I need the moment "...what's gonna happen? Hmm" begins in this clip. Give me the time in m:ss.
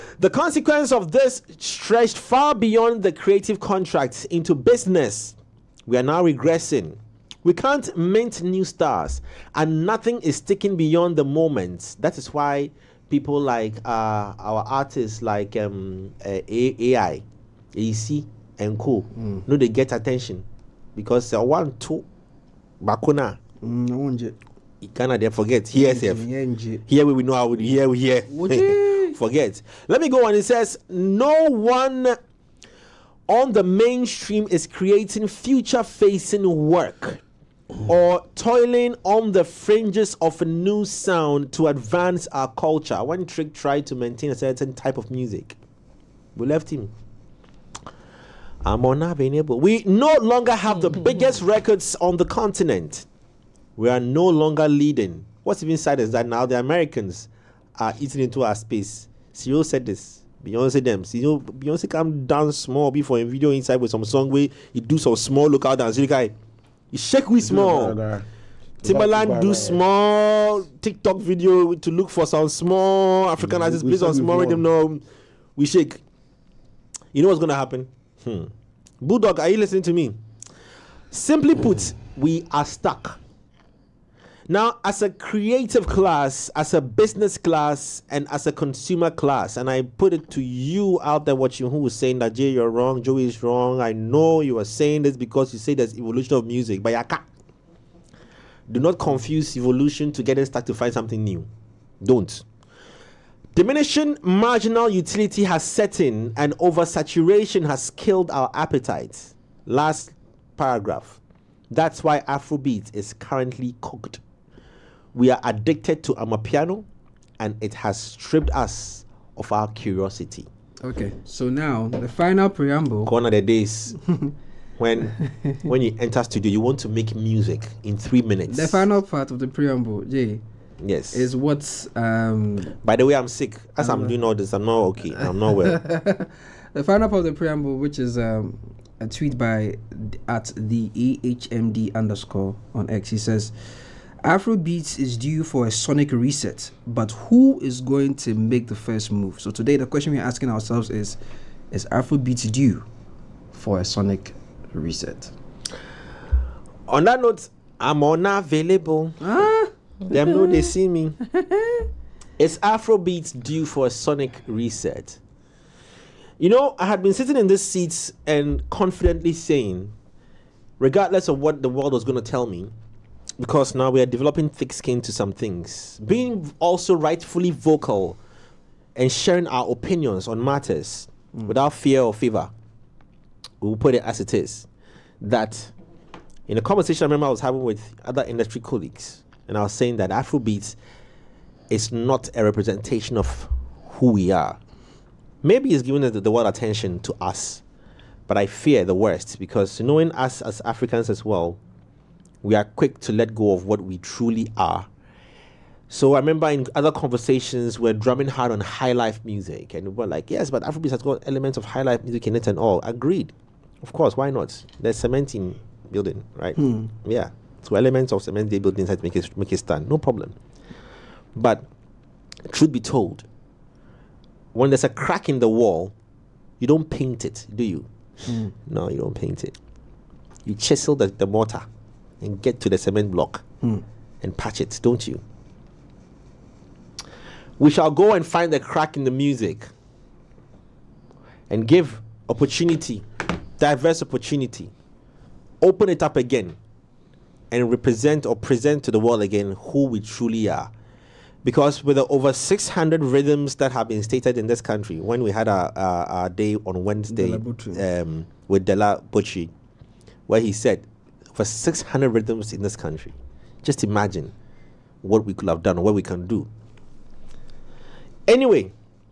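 1:17.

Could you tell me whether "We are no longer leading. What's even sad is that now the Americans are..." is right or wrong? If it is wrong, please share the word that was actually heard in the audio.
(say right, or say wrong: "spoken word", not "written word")
right.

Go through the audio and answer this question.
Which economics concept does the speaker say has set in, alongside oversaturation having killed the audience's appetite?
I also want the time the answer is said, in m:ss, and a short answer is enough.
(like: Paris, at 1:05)
Diminishing marginal utility, at 1:43.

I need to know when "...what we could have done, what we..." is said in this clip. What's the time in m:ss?
4:25.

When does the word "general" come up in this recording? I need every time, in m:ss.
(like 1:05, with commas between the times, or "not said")
not said.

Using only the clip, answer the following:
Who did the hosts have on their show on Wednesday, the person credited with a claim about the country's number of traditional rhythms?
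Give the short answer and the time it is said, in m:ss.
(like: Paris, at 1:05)
Della Bocci, at 4:18.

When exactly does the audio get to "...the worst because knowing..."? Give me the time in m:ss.
3:18.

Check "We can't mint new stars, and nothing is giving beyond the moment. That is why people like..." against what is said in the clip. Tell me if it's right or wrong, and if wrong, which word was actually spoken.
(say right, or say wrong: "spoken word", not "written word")
wrong: "sticking", not "giving".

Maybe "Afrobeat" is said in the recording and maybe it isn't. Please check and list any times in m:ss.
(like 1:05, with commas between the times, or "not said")
1:52, 2:24, 2:31, 2:42, 3:10, 3:30.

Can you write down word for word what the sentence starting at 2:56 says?
Being also rightfully vocal and sharing our opinions on matters mm.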